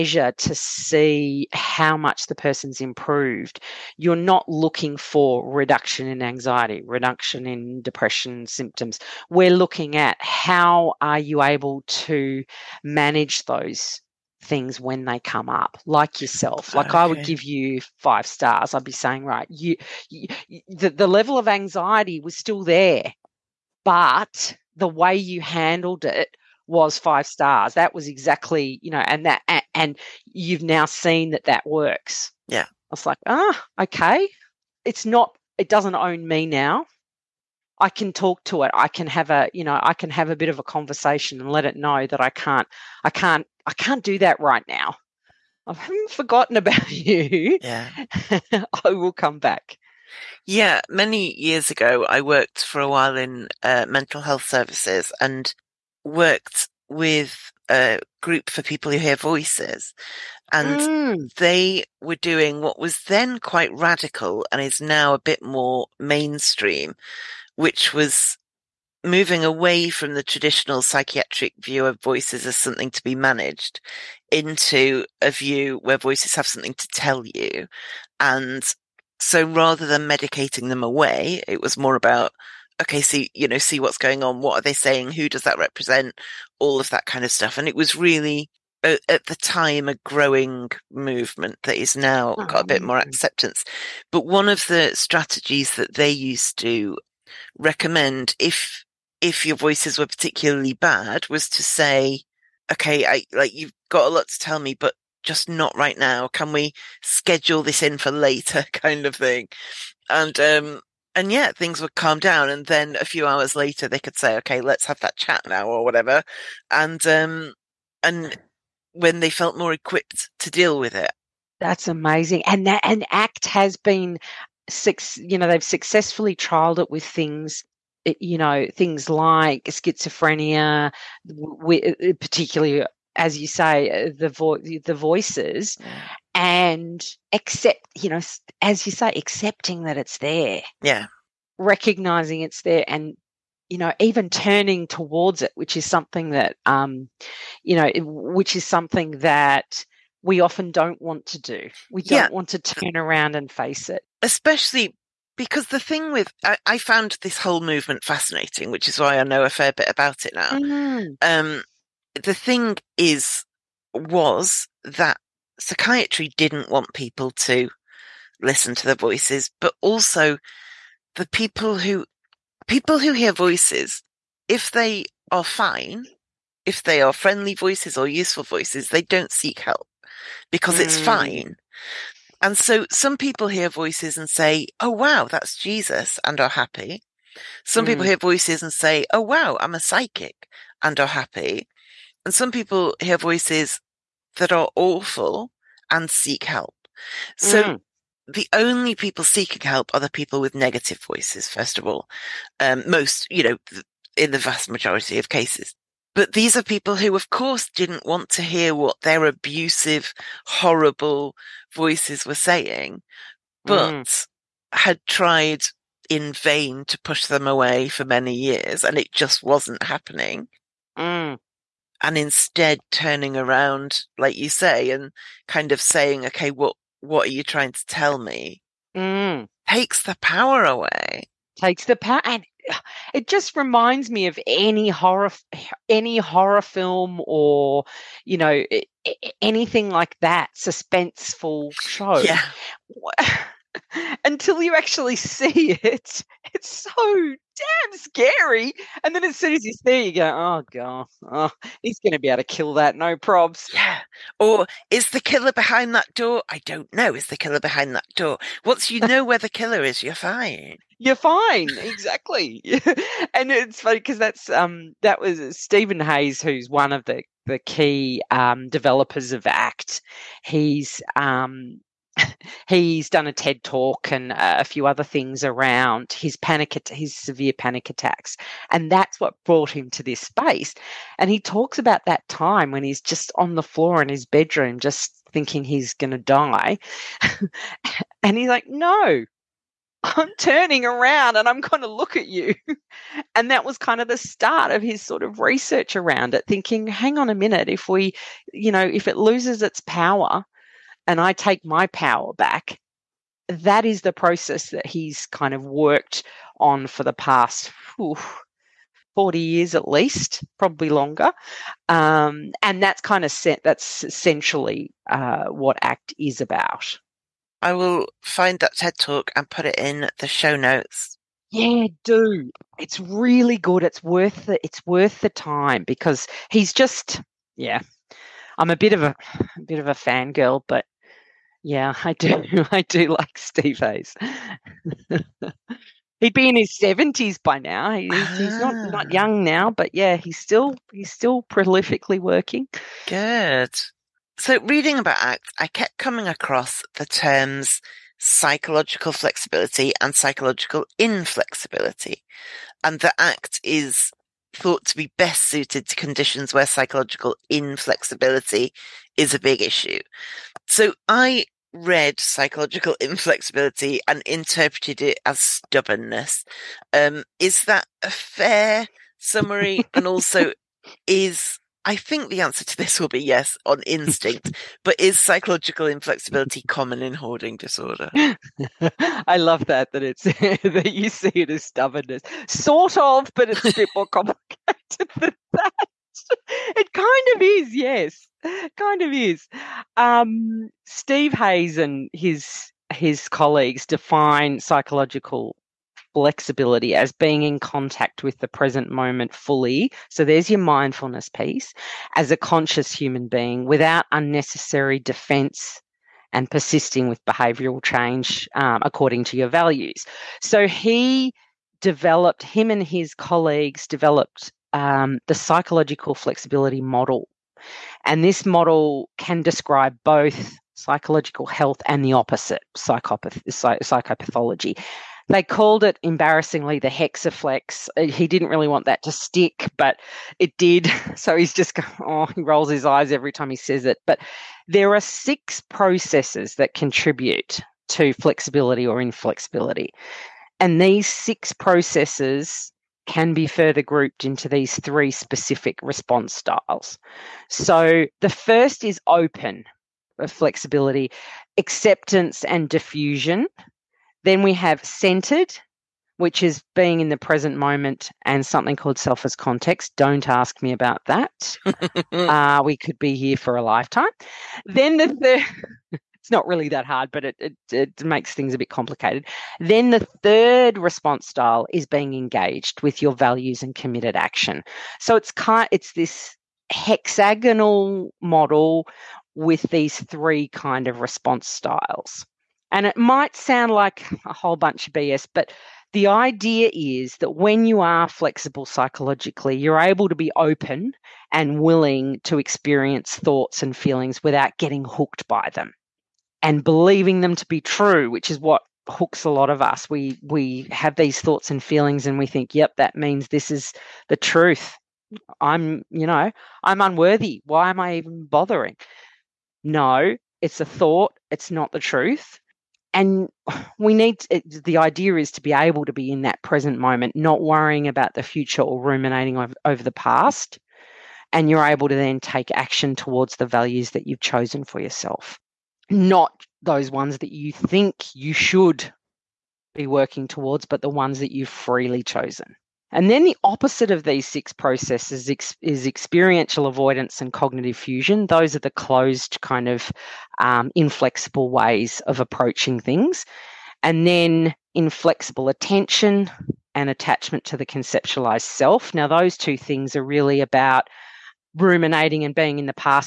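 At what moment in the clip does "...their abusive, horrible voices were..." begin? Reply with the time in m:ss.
3:29.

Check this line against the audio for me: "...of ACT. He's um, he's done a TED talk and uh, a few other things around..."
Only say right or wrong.
right.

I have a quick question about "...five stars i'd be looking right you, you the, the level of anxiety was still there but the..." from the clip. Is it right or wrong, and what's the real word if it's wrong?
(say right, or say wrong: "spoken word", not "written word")
wrong: "saying", not "looking".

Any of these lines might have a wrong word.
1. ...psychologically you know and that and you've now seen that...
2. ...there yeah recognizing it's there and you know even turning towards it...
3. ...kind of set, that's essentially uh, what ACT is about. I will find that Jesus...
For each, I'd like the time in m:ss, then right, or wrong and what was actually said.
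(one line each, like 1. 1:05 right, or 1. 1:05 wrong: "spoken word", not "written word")
1. 0:28 wrong: "exactly", not "psychologically"
2. 2:20 right
3. 5:13 wrong: "TED", not "Jesus".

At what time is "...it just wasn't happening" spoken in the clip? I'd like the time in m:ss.
3:38.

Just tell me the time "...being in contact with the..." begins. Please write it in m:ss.
6:37.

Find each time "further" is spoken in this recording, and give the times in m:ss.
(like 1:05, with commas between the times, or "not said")
7:23.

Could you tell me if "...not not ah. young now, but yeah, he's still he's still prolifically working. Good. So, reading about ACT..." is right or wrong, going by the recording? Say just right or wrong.
right.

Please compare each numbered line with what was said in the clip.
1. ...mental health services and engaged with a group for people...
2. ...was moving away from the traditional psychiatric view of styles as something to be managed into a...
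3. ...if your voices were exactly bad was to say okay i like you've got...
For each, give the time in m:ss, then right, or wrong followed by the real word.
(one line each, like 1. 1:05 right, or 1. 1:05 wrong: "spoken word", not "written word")
1. 0:53 wrong: "worked", not "engaged"
2. 1:07 wrong: "voices", not "styles"
3. 1:39 wrong: "particularly", not "exactly".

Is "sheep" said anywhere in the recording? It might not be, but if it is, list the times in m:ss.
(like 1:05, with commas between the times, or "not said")
not said.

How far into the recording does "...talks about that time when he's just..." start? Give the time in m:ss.
4:41.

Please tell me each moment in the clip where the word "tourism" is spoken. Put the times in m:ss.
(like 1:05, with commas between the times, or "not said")
not said.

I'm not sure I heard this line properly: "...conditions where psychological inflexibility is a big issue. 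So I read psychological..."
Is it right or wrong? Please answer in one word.
right.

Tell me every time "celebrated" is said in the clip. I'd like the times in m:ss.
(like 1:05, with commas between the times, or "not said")
not said.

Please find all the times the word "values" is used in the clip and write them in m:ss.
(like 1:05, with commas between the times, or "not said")
6:49, 7:53, 8:43.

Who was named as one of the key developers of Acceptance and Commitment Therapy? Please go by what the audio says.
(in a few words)
Stephen Hayes.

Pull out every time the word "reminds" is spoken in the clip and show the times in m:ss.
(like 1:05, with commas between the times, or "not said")
3:53.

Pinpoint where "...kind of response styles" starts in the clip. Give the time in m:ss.
8:00.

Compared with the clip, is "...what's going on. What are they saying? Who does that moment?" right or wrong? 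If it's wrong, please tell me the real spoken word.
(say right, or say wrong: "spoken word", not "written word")
wrong: "represent", not "moment".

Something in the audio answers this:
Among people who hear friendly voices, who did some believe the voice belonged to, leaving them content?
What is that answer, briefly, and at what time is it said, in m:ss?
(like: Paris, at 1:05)
Jesus, at 3:05.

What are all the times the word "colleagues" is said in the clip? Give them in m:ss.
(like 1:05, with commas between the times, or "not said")
6:33, 6:53.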